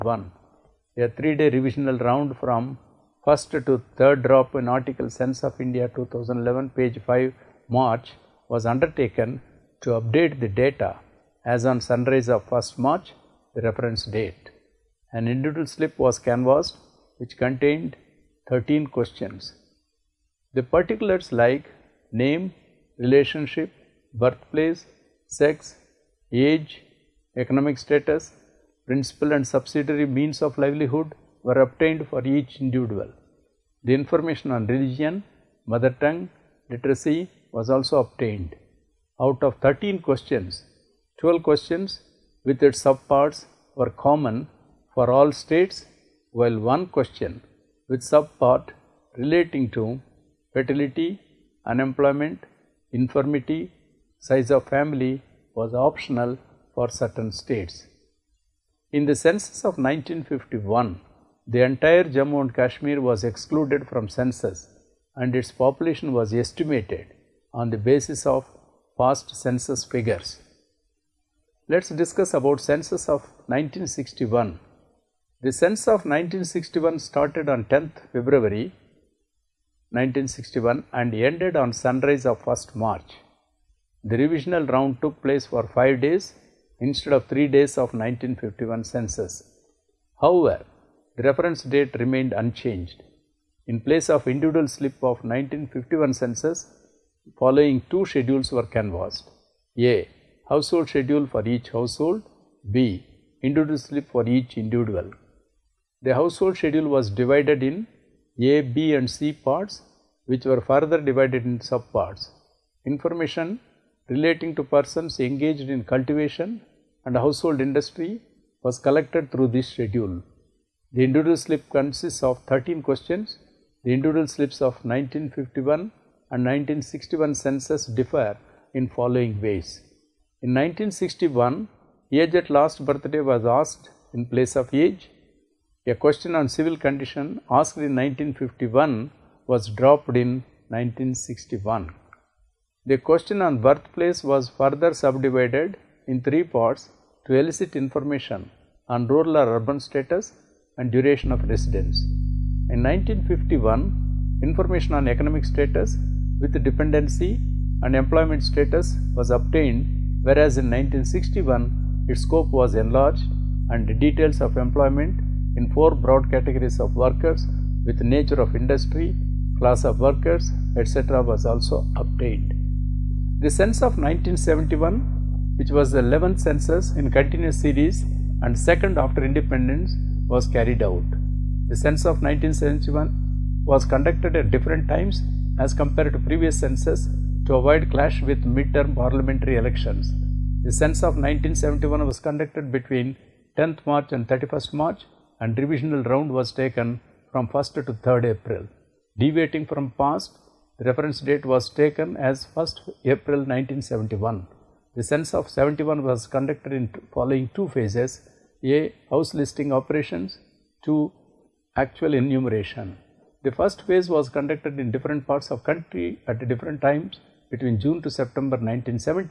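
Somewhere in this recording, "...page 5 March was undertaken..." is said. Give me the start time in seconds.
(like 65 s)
6 s.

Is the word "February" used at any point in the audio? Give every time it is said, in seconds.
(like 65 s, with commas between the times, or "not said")
78 s.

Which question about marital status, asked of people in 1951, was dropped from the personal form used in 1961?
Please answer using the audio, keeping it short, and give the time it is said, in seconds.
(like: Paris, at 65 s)
civil condition, at 136 s.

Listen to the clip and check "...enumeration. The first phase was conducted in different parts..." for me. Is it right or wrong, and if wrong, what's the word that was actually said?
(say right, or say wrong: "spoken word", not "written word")
right.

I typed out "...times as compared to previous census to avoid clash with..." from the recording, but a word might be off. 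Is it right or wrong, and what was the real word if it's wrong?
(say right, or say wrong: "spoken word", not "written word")
right.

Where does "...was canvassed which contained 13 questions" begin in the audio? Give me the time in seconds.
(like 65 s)
16 s.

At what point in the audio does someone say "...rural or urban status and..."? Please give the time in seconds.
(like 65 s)
149 s.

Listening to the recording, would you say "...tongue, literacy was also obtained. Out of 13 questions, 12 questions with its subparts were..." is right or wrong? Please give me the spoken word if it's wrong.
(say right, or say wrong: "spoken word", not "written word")
right.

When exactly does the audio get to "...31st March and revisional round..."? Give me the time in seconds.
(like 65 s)
194 s.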